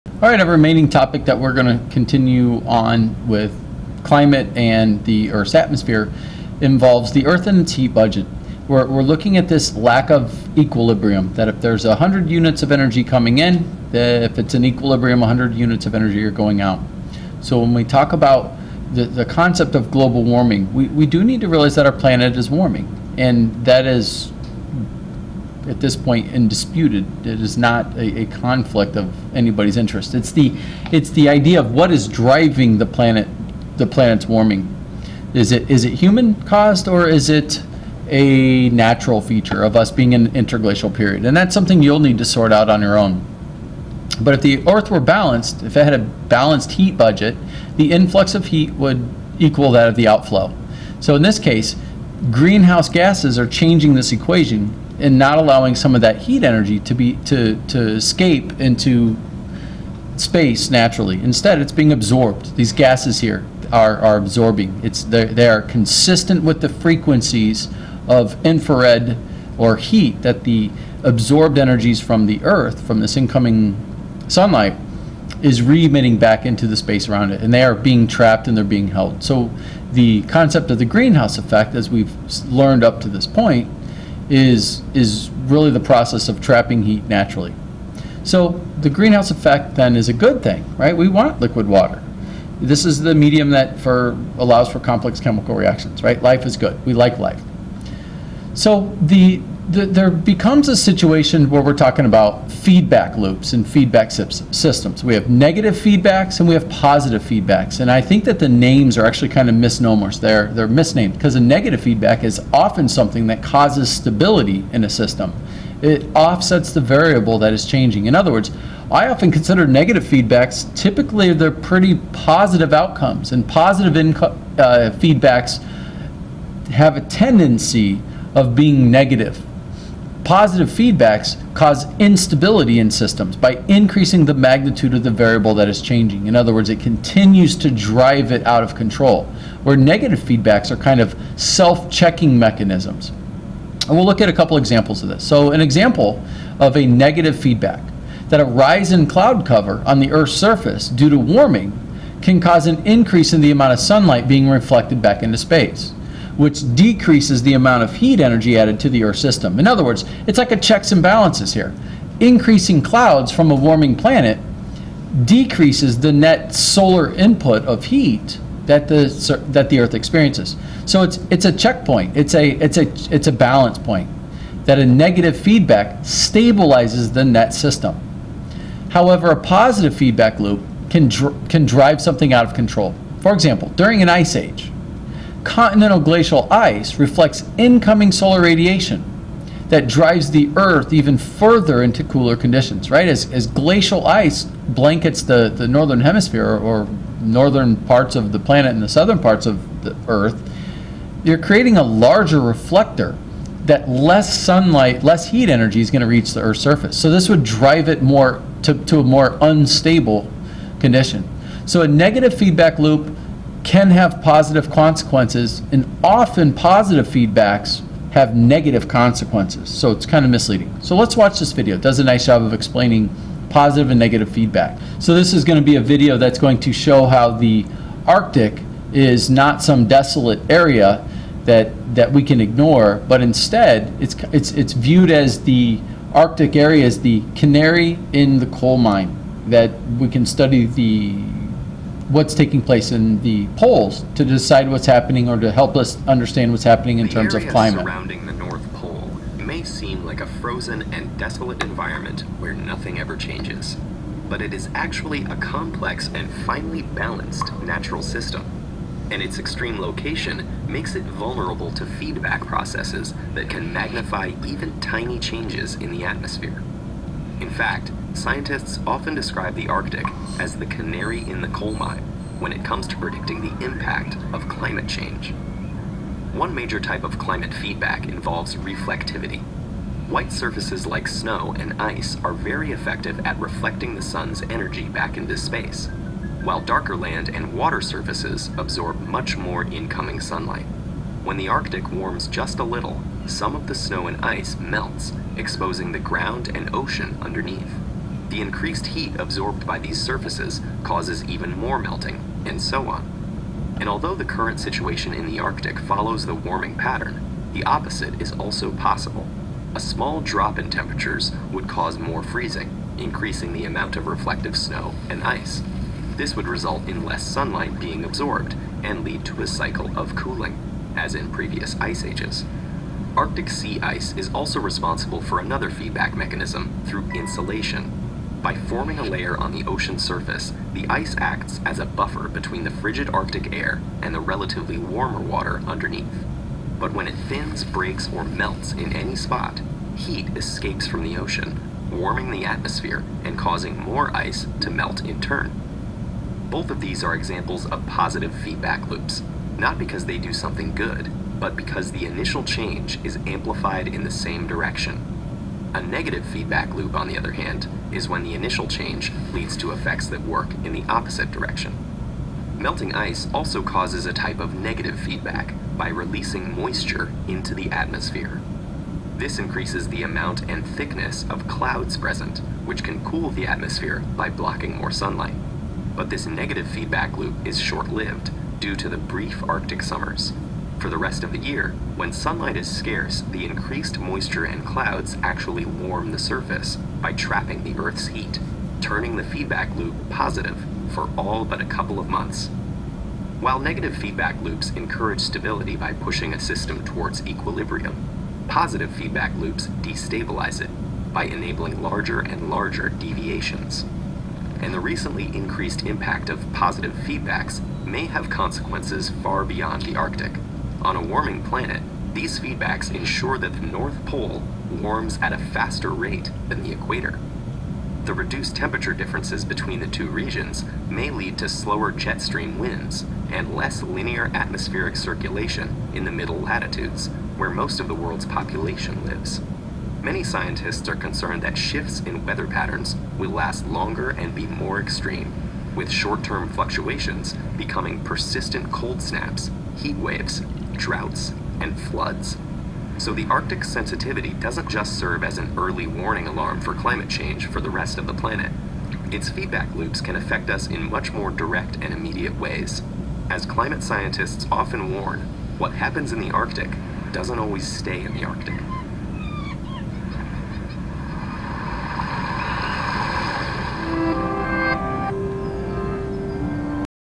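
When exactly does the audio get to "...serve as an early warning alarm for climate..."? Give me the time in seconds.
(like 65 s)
444 s.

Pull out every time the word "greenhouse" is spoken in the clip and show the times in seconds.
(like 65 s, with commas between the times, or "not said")
52 s, 80 s, 88 s.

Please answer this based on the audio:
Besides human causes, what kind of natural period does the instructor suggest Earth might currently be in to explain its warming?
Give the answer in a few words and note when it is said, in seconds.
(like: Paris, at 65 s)
interglacial period, at 40 s.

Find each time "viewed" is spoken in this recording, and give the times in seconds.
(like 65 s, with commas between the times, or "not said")
234 s.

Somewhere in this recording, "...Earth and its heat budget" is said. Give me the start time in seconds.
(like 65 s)
7 s.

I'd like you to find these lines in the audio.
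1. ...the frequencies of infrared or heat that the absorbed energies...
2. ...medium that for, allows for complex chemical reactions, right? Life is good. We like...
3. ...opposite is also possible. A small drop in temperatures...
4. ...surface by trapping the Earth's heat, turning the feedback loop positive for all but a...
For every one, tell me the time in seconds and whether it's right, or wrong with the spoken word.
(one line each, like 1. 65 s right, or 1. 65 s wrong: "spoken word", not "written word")
1. 66 s right
2. 93 s right
3. 307 s right
4. 386 s right.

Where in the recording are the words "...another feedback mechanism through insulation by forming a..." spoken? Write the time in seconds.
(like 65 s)
325 s.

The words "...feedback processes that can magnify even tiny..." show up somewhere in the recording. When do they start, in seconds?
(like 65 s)
261 s.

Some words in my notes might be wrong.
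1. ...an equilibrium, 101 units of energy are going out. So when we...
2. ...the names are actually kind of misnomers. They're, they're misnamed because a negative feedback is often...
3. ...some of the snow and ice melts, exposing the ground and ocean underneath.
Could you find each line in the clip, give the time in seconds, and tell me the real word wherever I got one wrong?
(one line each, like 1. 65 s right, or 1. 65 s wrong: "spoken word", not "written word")
1. 14 s wrong: "100", not "101"
2. 108 s right
3. 293 s right.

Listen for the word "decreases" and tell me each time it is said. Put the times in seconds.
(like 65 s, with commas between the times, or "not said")
156 s, 165 s.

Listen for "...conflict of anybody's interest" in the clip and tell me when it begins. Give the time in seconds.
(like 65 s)
28 s.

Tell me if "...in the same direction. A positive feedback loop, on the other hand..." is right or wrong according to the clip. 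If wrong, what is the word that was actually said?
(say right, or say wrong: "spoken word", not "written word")
wrong: "negative", not "positive".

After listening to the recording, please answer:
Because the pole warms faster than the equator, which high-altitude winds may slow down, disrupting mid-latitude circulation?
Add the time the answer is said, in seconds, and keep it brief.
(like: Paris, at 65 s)
jet stream winds, at 421 s.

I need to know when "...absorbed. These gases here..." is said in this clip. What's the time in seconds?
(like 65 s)
61 s.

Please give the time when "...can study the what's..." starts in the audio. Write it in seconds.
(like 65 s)
240 s.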